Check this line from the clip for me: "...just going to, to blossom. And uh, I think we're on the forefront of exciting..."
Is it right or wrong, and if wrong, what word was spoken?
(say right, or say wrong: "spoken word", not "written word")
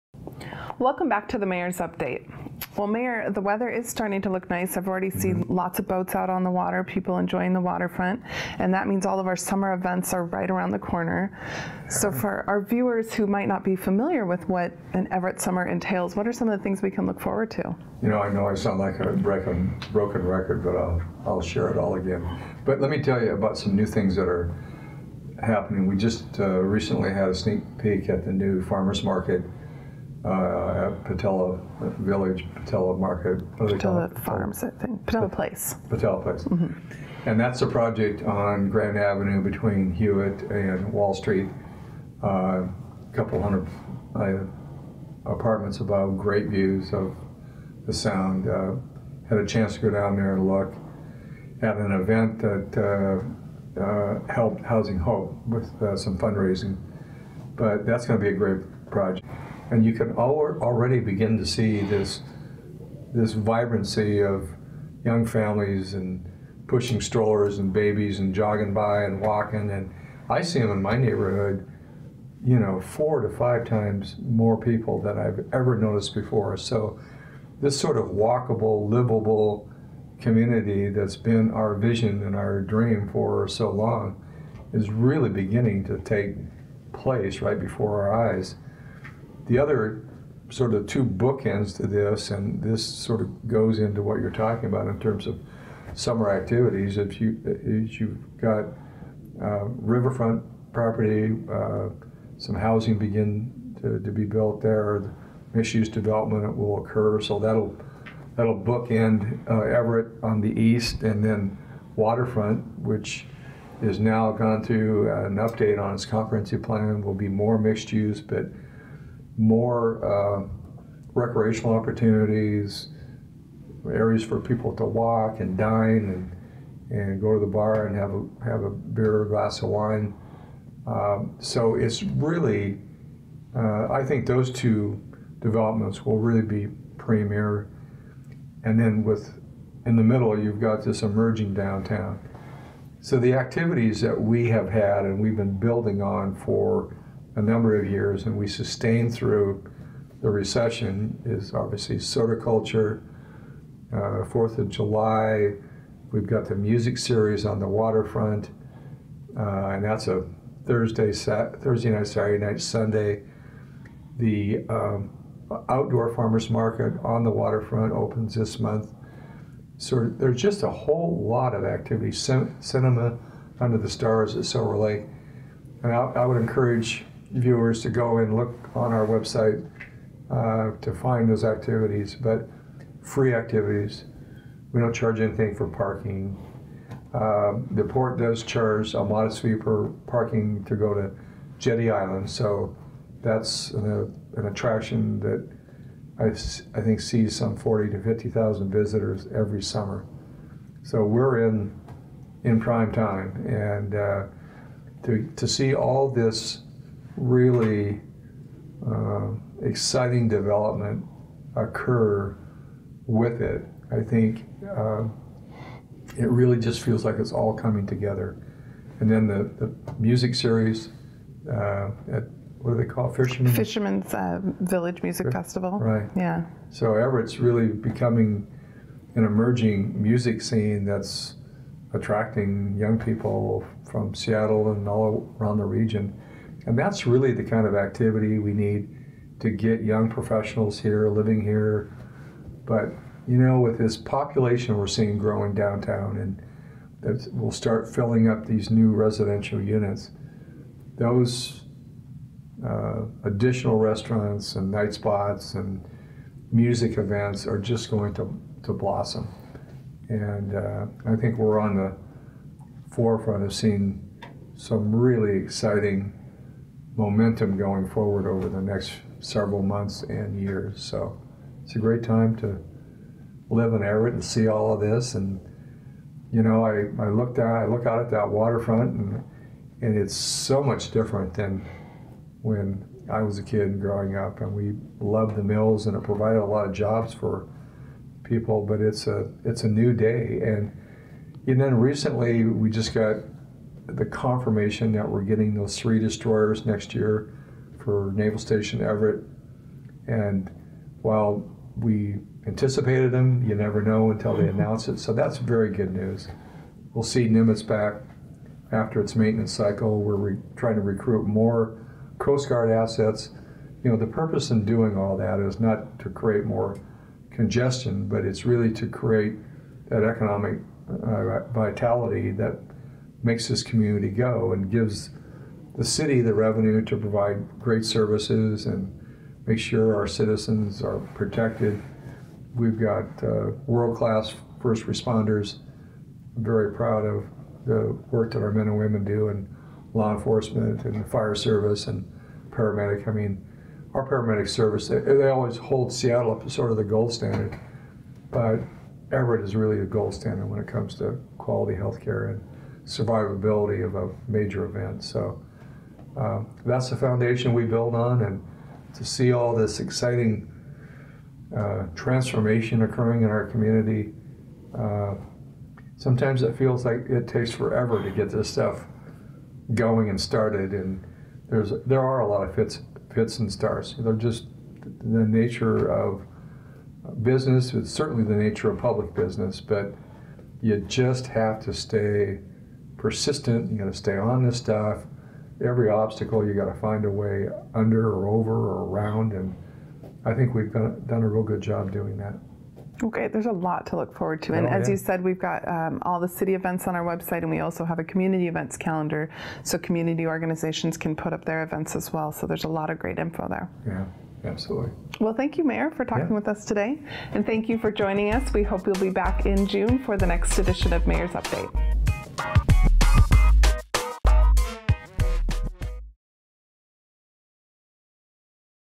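wrong: "seeing", not "exciting".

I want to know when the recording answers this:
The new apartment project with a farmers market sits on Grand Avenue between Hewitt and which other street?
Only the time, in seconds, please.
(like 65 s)
40 s.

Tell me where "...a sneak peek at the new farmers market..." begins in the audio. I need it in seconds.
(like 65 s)
27 s.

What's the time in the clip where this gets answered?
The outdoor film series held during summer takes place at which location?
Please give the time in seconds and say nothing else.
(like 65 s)
174 s.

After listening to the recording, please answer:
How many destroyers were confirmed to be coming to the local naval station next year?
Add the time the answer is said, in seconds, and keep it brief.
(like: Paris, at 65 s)
3, at 295 s.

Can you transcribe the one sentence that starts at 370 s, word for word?
And there's there are a lot of fits fits and starts.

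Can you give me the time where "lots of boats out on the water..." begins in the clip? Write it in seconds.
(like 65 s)
5 s.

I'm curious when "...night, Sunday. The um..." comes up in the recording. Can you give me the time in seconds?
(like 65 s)
162 s.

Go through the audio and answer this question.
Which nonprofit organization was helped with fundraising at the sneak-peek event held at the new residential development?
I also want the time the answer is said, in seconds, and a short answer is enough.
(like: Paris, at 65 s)
Housing Hope, at 54 s.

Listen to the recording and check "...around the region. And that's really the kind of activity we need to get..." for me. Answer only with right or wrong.
right.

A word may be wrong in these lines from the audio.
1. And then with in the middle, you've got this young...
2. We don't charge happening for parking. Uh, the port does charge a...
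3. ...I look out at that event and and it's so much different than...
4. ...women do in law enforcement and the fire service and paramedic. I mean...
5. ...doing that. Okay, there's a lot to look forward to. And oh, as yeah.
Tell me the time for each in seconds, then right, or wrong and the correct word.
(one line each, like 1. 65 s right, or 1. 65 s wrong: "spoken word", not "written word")
1. 138 s wrong: "emerging", not "young"
2. 184 s wrong: "anything", not "happening"
3. 277 s wrong: "waterfront", not "event"
4. 338 s right
5. 391 s right.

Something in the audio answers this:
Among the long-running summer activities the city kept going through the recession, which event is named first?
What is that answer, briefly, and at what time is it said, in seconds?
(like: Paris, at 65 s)
Sorticulture, at 151 s.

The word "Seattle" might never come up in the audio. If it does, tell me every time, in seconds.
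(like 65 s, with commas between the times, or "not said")
234 s, 345 s.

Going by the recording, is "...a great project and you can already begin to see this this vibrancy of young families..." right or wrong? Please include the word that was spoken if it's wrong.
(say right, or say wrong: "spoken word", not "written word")
right.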